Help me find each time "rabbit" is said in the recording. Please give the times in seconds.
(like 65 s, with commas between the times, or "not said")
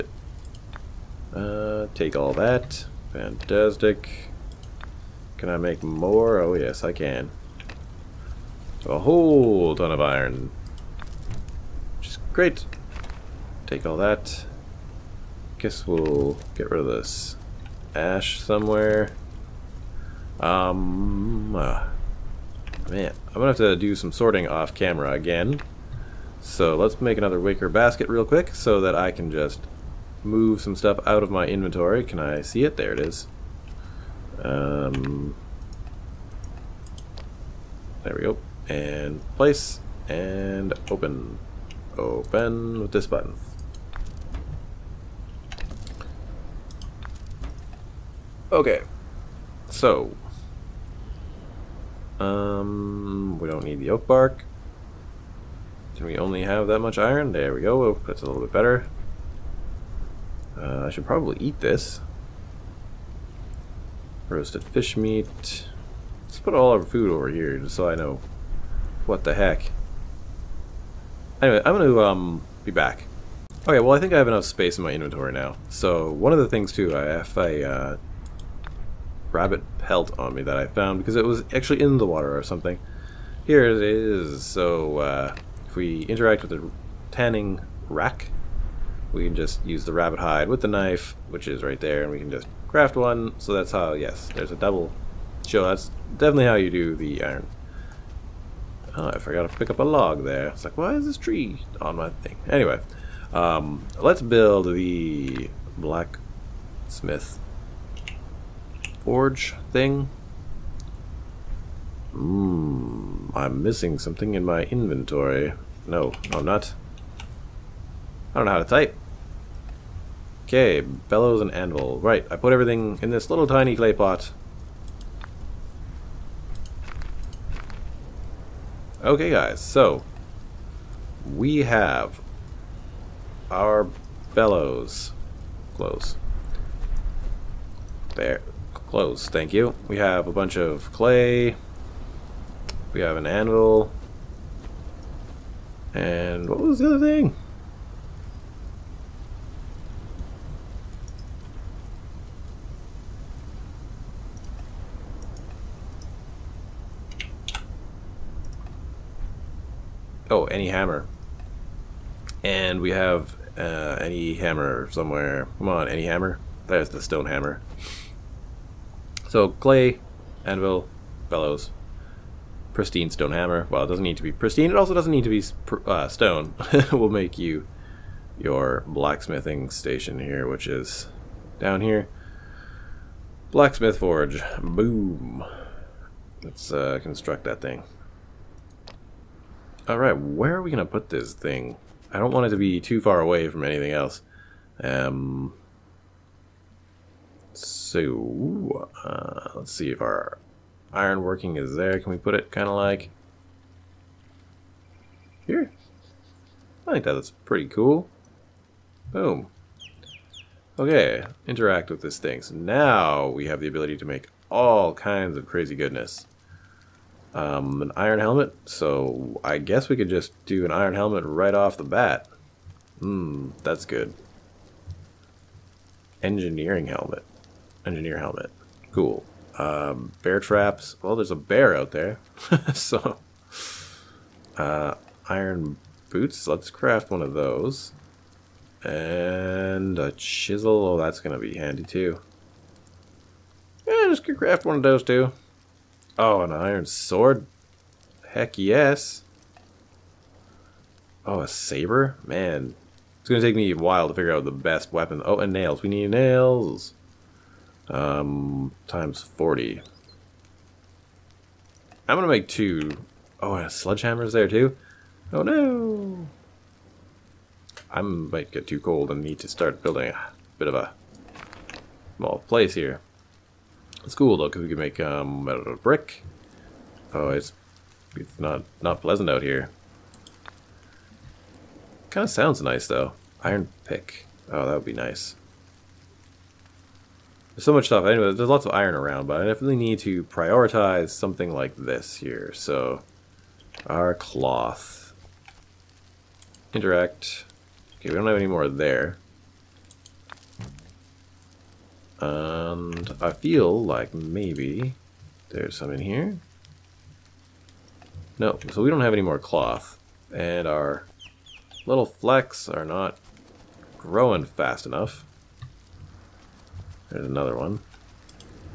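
79 s, 89 s.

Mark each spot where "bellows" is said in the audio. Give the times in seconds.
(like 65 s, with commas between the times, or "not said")
120 s, 134 s, 171 s.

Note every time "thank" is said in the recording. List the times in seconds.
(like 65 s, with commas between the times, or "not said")
139 s.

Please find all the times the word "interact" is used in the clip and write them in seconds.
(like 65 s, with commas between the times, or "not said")
86 s, 211 s, 296 s.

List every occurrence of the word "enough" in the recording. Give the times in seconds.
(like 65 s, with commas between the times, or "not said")
74 s, 314 s.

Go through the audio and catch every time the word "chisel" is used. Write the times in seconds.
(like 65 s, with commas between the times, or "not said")
240 s.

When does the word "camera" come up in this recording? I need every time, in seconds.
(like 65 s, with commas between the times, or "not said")
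24 s.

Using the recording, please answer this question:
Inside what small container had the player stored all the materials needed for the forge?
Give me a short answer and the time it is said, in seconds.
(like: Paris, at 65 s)
Clay pot, at 123 s.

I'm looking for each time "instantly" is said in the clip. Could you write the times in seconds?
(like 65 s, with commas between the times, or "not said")
not said.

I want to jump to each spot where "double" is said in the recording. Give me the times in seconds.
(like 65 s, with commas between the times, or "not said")
94 s.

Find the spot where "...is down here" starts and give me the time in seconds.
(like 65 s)
180 s.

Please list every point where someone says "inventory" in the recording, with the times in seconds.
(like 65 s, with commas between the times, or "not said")
31 s, 74 s, 114 s.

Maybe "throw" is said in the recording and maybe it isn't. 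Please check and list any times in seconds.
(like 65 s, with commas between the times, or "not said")
not said.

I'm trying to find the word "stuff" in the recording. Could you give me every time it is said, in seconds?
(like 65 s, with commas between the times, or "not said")
30 s, 287 s.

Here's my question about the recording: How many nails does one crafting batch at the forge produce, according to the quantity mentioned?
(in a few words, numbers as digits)
40.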